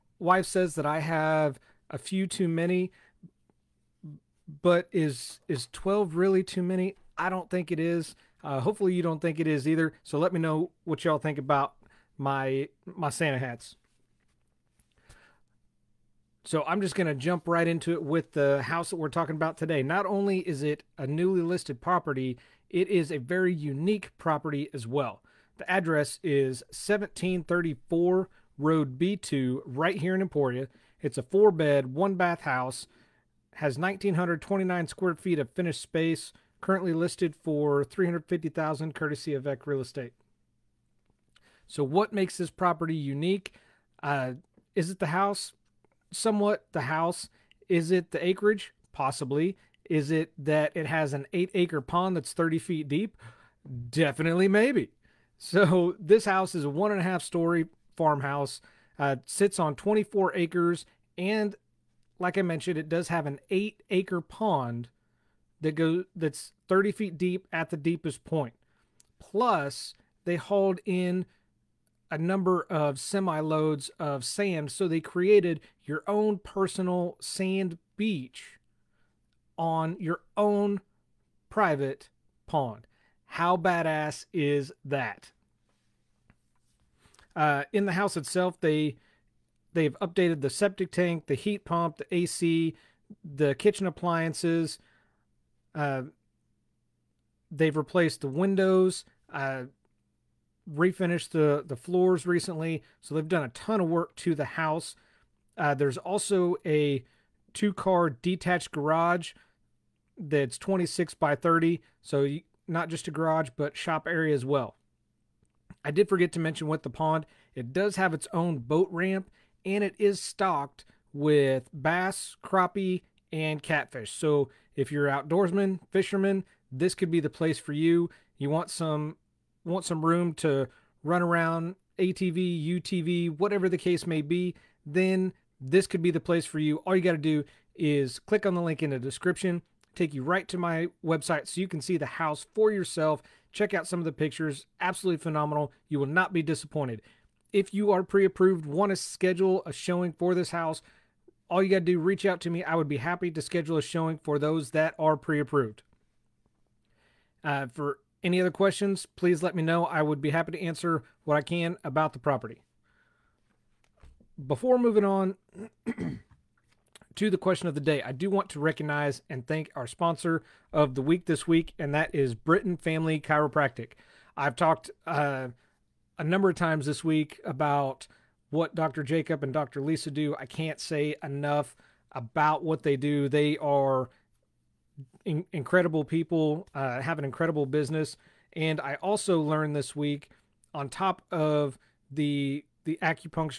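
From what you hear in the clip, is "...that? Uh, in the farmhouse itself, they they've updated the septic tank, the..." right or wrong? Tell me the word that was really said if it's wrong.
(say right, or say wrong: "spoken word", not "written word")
wrong: "house", not "farmhouse".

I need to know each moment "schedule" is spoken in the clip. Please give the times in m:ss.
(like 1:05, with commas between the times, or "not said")
2:28, 2:33.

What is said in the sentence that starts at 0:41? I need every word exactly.
So what makes this property unique?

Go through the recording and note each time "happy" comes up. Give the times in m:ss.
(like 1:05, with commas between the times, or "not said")
2:32, 2:40.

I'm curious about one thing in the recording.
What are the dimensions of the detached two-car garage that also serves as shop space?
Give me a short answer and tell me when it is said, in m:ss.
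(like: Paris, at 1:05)
26 by 30, at 1:50.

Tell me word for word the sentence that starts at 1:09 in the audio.
Plus, they hauled in a number of semi loads of sand.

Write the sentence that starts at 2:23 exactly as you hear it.
Check out some of the pictures, absolutely phenomenal.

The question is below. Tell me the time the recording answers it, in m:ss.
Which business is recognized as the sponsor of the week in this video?
2:52.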